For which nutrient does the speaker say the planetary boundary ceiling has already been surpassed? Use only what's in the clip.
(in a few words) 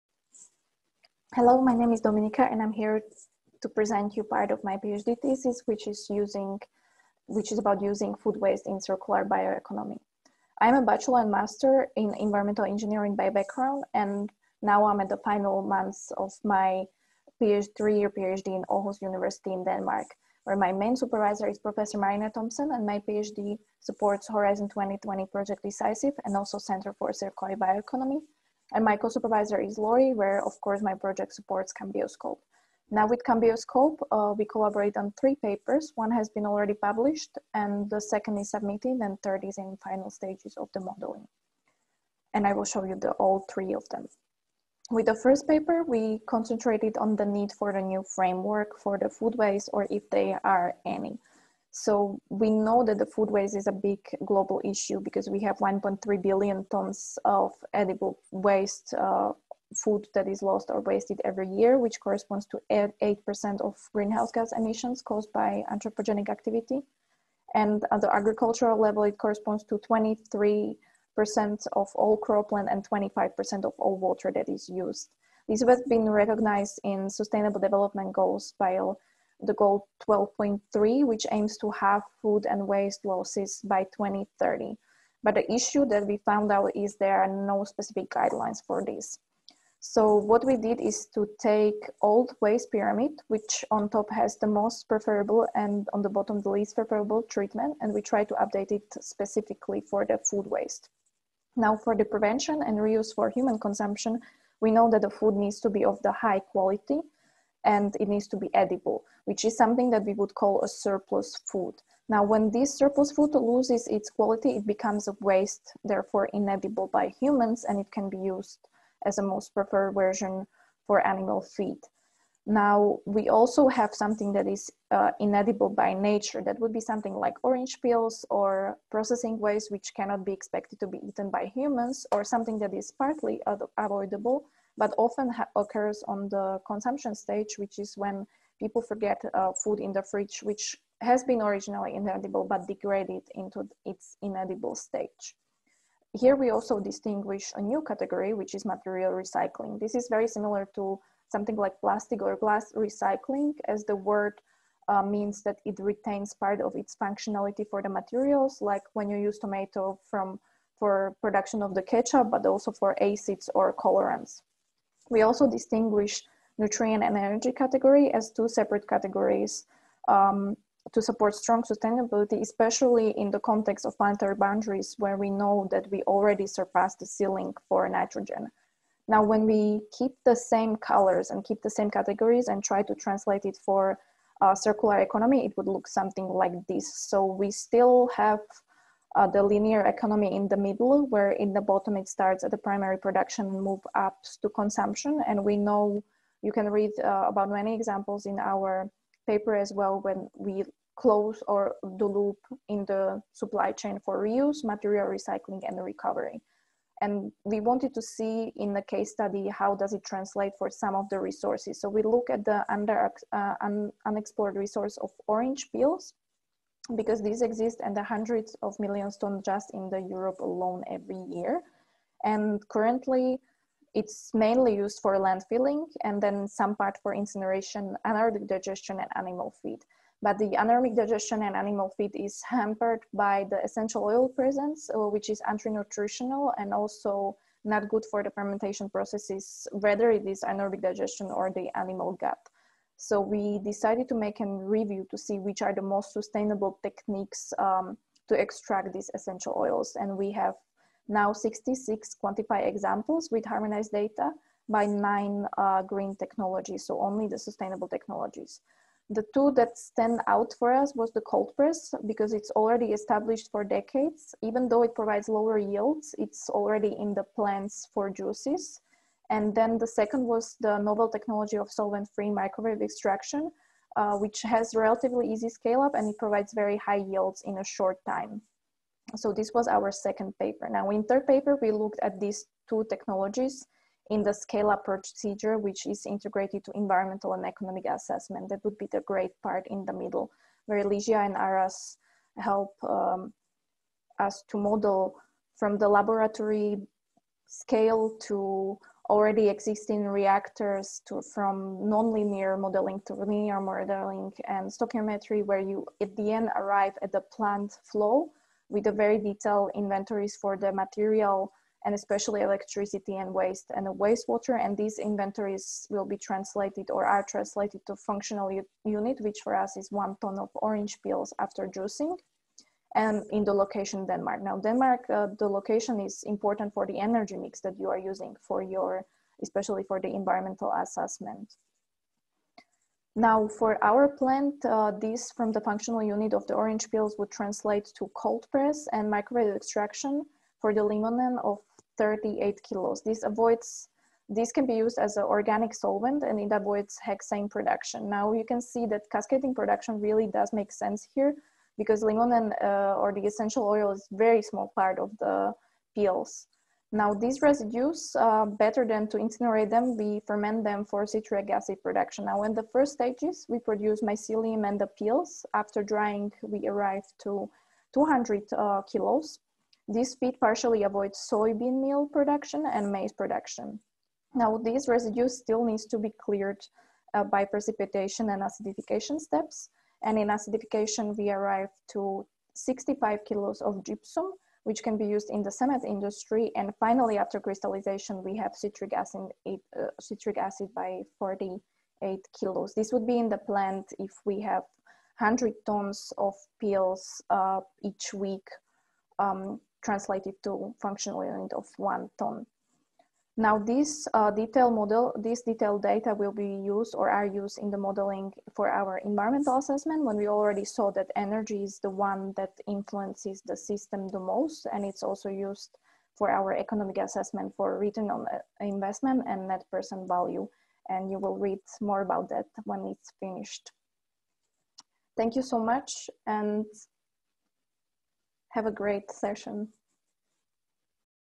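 nitrogen.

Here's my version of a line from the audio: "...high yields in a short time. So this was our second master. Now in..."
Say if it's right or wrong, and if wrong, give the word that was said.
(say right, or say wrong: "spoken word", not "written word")
wrong: "paper", not "master".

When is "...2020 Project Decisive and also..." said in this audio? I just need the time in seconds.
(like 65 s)
24 s.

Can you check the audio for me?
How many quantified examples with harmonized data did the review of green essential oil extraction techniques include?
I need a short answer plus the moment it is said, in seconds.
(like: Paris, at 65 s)
66, at 251 s.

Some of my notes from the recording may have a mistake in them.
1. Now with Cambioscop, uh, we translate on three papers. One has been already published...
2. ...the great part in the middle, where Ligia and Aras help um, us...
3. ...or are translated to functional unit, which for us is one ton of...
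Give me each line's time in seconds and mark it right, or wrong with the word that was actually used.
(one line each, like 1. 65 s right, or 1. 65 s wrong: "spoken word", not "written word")
1. 32 s wrong: "collaborate", not "translate"
2. 288 s right
3. 316 s right.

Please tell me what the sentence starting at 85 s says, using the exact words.
But the issue that we found out is there are no specific guidelines for this.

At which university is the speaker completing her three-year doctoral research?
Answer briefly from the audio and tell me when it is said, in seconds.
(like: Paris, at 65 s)
Aarhus University, at 18 s.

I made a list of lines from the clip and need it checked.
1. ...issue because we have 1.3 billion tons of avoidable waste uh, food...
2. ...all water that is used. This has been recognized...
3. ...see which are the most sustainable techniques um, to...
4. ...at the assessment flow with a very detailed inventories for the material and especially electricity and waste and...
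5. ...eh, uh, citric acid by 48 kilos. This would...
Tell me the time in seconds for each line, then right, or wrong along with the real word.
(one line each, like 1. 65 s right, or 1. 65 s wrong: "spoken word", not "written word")
1. 54 s wrong: "edible", not "avoidable"
2. 73 s right
3. 245 s right
4. 307 s wrong: "plant", not "assessment"
5. 389 s right.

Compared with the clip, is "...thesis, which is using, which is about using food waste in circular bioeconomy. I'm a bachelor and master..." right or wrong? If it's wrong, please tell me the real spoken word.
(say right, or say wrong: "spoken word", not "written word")
right.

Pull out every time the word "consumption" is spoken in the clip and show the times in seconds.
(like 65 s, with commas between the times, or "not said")
103 s, 136 s, 194 s.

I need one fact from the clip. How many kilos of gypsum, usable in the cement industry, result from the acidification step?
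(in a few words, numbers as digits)
65.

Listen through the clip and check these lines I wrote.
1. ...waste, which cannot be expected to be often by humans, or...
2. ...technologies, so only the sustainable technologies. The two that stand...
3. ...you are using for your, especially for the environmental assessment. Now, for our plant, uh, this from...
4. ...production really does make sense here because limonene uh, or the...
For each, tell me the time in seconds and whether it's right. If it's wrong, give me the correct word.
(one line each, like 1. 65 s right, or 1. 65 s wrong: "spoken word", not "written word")
1. 129 s wrong: "eaten", not "often"
2. 256 s right
3. 327 s right
4. 349 s right.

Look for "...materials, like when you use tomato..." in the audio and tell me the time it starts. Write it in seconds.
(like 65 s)
157 s.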